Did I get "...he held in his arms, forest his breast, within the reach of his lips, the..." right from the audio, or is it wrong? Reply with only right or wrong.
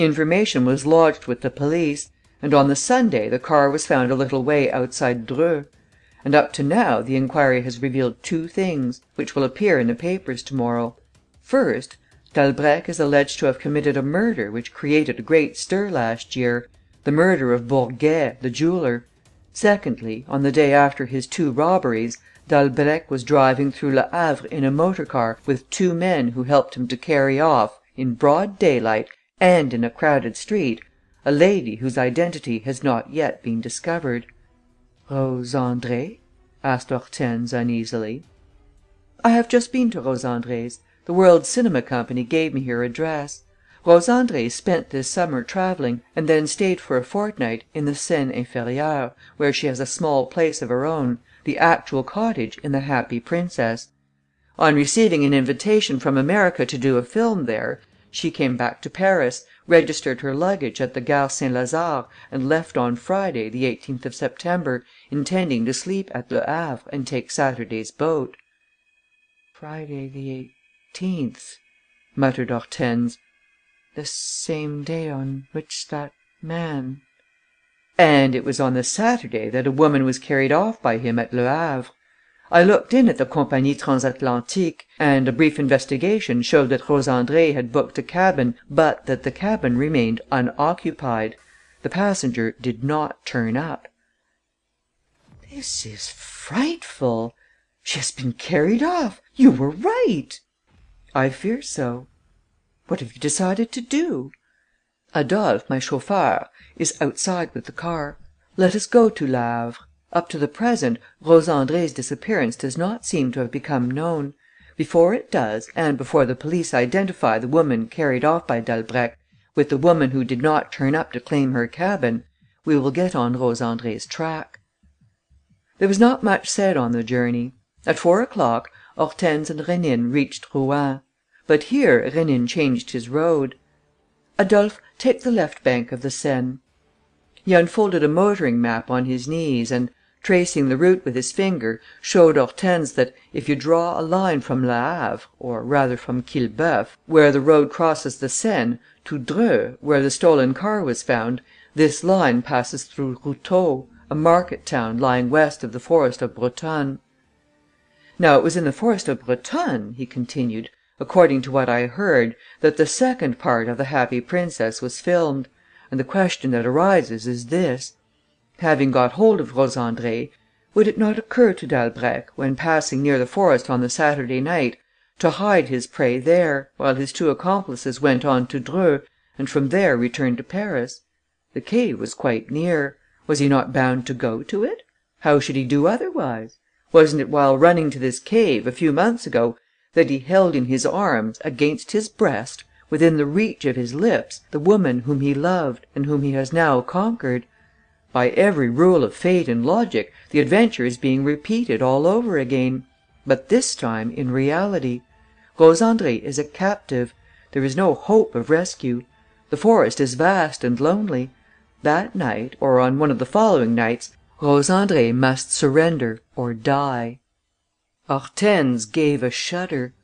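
wrong.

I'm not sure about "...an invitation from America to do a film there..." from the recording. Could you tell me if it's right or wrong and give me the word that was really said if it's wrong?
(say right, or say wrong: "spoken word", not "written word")
right.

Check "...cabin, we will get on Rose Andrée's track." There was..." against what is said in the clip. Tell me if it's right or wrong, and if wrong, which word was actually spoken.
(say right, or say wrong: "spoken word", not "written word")
right.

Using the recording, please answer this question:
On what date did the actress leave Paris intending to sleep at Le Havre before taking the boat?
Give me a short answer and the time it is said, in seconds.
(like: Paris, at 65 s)
September 18, at 63 s.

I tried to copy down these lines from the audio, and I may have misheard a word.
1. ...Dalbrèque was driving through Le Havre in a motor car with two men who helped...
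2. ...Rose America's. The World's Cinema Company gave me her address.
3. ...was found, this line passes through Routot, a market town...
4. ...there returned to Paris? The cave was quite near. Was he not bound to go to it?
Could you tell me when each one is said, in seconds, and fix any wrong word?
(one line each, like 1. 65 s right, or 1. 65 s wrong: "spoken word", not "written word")
1. 22 s right
2. 39 s wrong: "Andrée", not "America"
3. 150 s right
4. 179 s right.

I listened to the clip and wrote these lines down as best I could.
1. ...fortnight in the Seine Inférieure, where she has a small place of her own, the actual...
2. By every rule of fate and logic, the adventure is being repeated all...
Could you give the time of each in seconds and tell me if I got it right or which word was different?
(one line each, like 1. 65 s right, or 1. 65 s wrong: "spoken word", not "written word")
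1. 47 s right
2. 198 s right.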